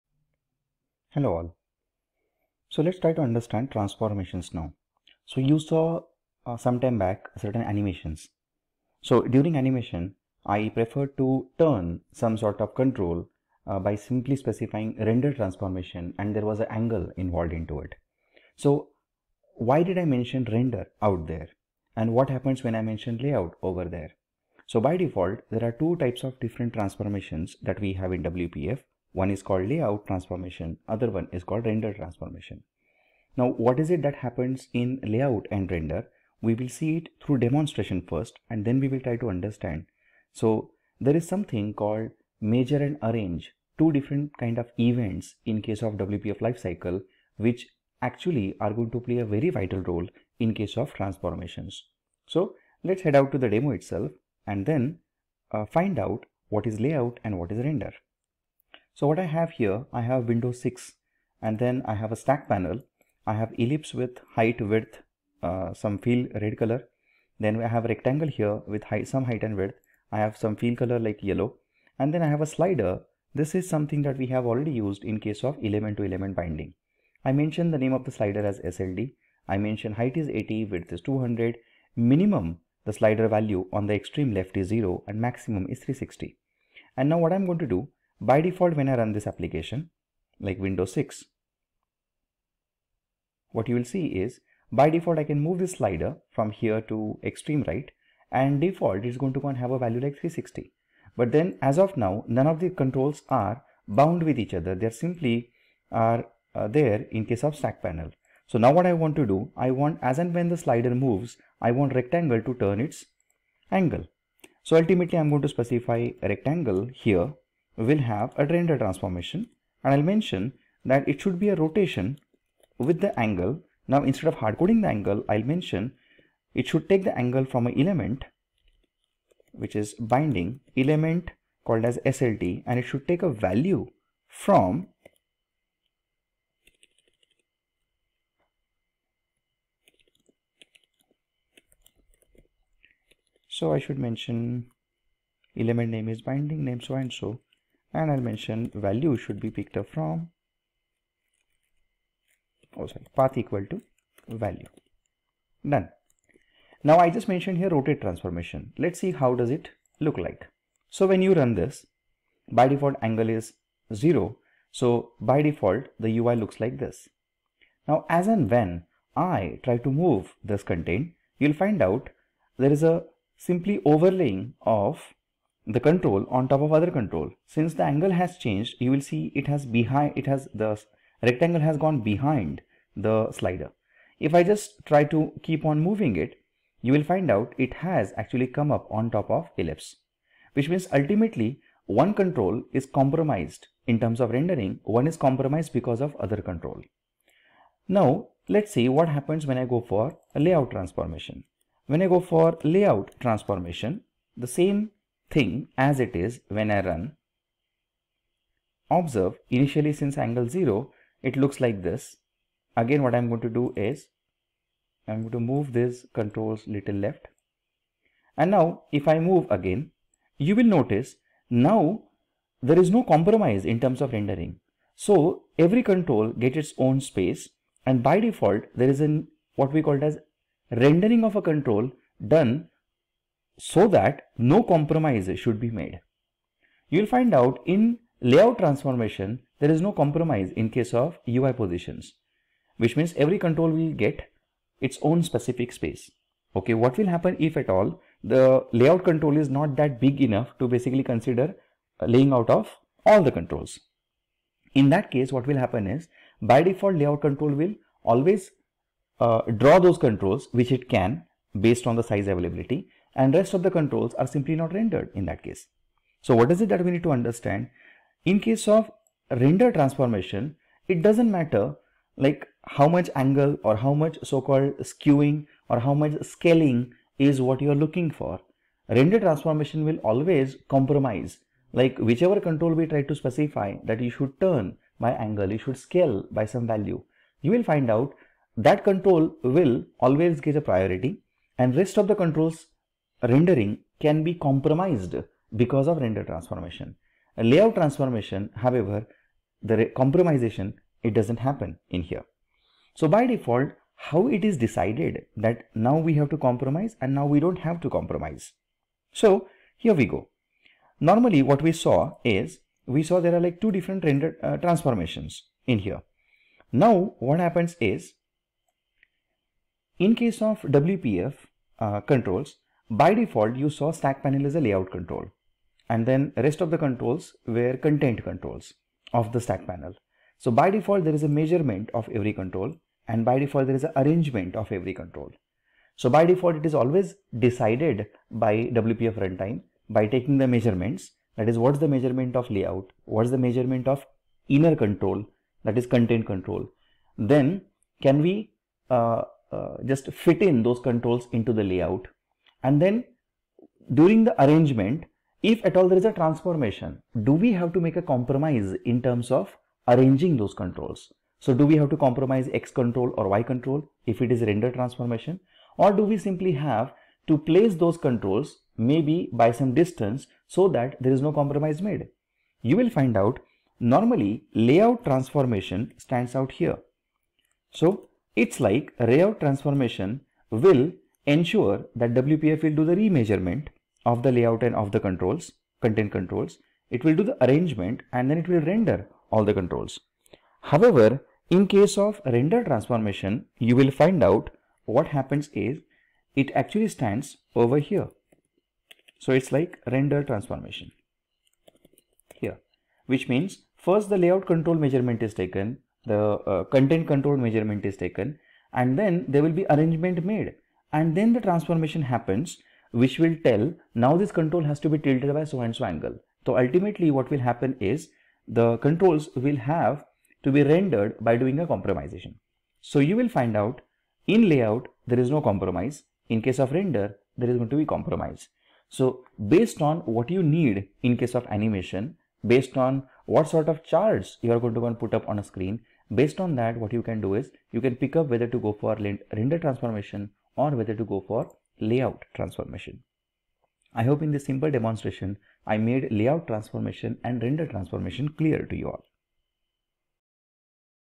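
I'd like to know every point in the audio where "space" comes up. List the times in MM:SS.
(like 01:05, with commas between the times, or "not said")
03:47, 04:05.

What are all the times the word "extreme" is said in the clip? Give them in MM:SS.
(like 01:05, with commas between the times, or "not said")
01:23, 01:37.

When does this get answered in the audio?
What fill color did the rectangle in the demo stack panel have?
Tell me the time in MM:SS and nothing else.
01:11.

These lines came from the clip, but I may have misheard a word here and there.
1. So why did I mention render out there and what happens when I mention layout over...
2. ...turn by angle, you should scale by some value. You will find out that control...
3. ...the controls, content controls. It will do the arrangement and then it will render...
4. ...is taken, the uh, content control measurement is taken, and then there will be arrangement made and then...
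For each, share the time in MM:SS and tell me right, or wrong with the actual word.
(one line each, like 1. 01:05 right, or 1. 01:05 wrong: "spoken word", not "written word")
1. 00:18 right
2. 04:44 right
3. 06:24 right
4. 06:45 right.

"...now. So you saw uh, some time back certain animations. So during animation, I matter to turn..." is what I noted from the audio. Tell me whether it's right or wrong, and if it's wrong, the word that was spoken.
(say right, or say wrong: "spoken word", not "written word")
wrong: "prefer", not "matter".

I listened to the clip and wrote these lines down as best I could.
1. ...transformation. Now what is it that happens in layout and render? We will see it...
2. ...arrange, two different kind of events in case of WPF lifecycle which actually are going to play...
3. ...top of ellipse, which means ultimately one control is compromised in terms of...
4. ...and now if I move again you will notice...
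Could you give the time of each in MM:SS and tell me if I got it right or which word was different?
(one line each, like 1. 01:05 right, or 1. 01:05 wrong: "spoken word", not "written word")
1. 00:31 right
2. 00:43 right
3. 03:09 right
4. 03:38 right.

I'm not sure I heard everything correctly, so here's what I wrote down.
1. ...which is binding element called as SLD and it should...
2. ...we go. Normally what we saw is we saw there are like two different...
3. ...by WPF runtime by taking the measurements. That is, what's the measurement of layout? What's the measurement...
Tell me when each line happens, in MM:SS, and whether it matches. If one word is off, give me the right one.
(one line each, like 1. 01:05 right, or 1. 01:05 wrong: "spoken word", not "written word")
1. 02:09 right
2. 05:09 right
3. 05:38 right.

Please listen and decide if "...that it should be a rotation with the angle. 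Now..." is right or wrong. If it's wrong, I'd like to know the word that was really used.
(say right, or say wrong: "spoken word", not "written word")
right.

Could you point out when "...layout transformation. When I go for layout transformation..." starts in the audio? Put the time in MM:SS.
03:20.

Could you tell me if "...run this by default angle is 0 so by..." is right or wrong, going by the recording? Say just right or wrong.
right.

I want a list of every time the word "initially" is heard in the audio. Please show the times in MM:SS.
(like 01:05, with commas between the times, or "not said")
03:29.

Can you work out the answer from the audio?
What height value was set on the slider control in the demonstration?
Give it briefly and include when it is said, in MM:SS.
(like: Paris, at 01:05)
80, at 01:20.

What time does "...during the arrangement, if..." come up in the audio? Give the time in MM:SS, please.
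05:53.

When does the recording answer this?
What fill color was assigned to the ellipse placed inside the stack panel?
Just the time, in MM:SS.
01:06.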